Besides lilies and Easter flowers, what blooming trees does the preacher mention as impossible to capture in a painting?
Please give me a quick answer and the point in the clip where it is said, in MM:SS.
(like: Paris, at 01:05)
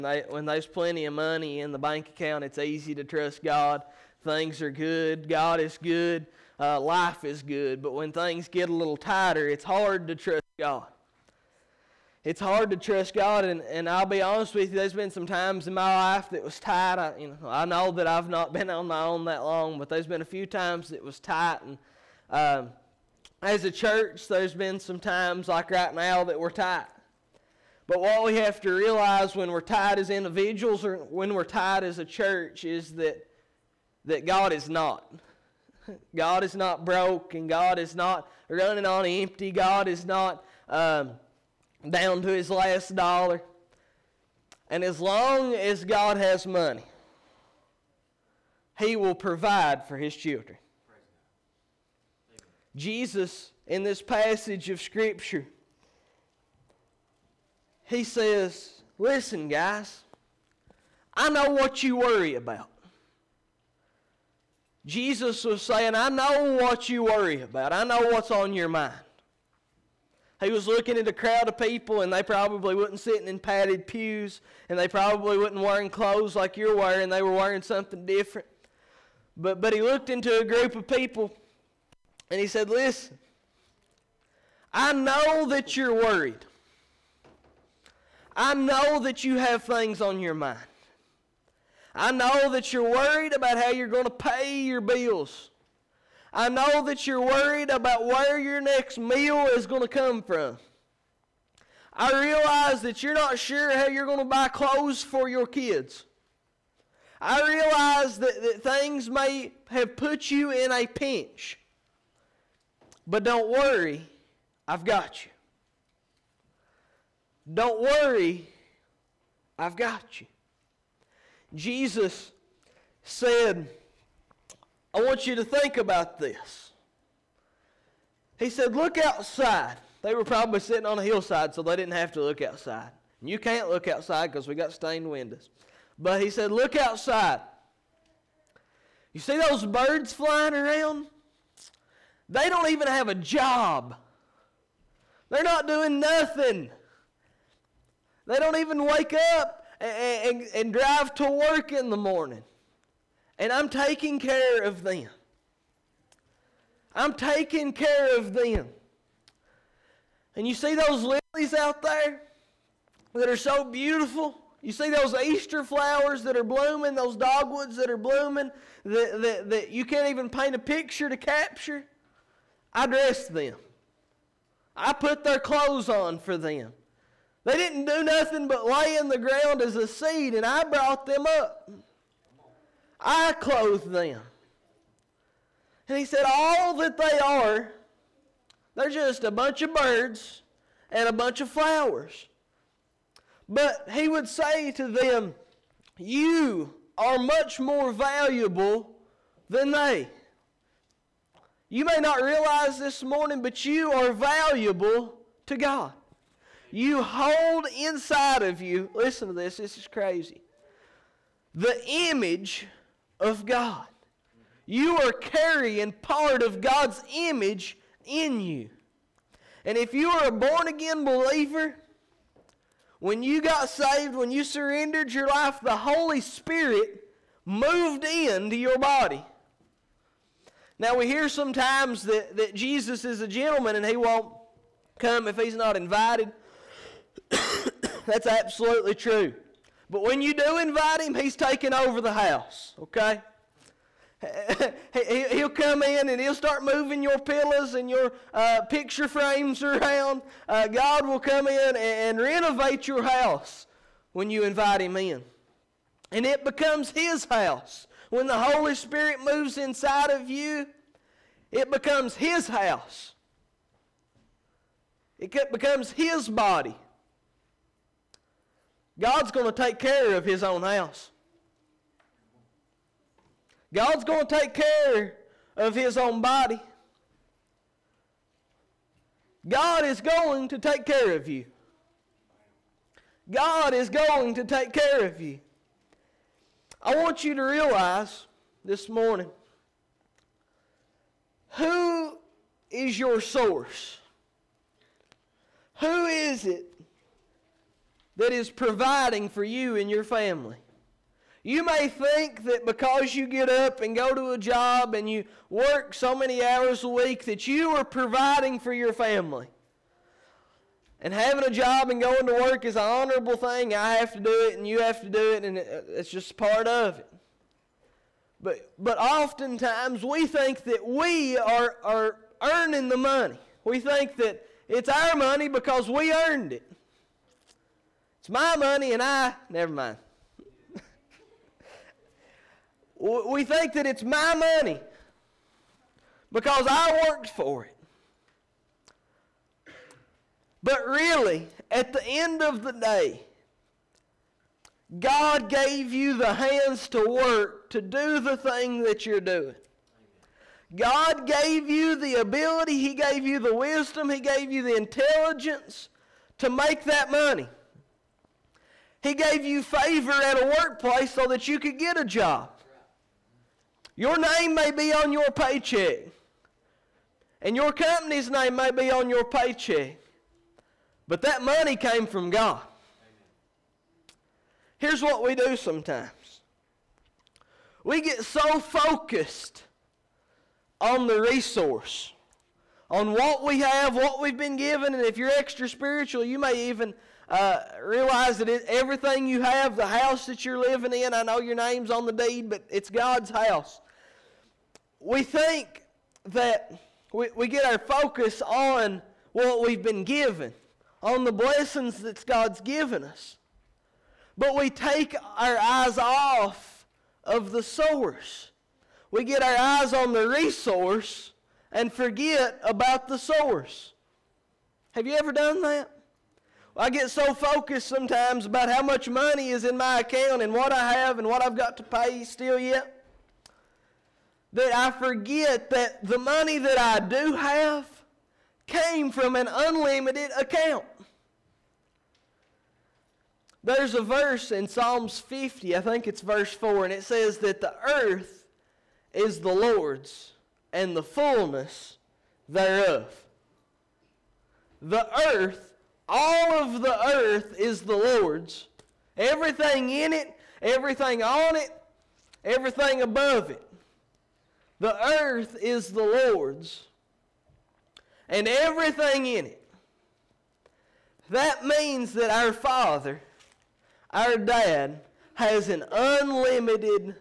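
dogwoods, at 02:47.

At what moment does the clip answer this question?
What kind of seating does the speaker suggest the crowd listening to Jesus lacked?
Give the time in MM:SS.
01:13.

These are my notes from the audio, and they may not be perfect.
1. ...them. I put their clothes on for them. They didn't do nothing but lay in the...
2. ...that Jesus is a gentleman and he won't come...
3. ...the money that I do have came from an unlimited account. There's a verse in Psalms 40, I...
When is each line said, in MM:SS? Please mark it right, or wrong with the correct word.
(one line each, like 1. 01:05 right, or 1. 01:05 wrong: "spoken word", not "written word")
1. 02:53 right
2. 03:52 right
3. 07:06 wrong: "50", not "40".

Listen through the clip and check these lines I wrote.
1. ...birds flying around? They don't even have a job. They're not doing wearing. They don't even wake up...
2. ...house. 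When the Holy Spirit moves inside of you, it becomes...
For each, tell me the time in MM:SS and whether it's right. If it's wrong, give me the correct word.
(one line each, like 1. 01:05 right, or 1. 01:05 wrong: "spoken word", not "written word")
1. 02:19 wrong: "nothing", not "wearing"
2. 04:17 right.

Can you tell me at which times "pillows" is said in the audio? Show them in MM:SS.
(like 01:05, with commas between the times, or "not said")
04:07.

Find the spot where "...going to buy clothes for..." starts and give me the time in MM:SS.
01:44.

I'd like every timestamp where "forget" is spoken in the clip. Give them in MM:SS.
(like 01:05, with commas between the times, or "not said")
06:51, 07:04.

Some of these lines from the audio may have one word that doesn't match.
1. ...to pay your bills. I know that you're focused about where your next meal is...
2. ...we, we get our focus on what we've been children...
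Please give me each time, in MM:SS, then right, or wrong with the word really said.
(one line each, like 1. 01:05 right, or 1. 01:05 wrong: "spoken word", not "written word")
1. 01:34 wrong: "worried", not "focused"
2. 06:37 wrong: "given", not "children".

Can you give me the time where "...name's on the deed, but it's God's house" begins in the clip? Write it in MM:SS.
06:31.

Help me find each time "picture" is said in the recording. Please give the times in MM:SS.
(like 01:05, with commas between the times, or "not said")
02:50, 04:08.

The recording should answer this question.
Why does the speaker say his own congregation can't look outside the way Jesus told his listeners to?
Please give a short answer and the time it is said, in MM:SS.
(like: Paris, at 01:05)
stained windows, at 02:14.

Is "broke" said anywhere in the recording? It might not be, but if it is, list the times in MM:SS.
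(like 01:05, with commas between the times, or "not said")
00:36.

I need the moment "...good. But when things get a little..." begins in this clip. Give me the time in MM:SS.
00:07.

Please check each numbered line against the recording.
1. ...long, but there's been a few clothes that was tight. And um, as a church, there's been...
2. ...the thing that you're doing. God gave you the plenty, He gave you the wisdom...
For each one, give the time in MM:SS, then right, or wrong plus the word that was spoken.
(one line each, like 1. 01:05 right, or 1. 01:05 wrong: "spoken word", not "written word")
1. 00:19 wrong: "times", not "clothes"
2. 05:48 wrong: "ability", not "plenty".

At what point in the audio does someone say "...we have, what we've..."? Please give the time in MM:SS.
06:23.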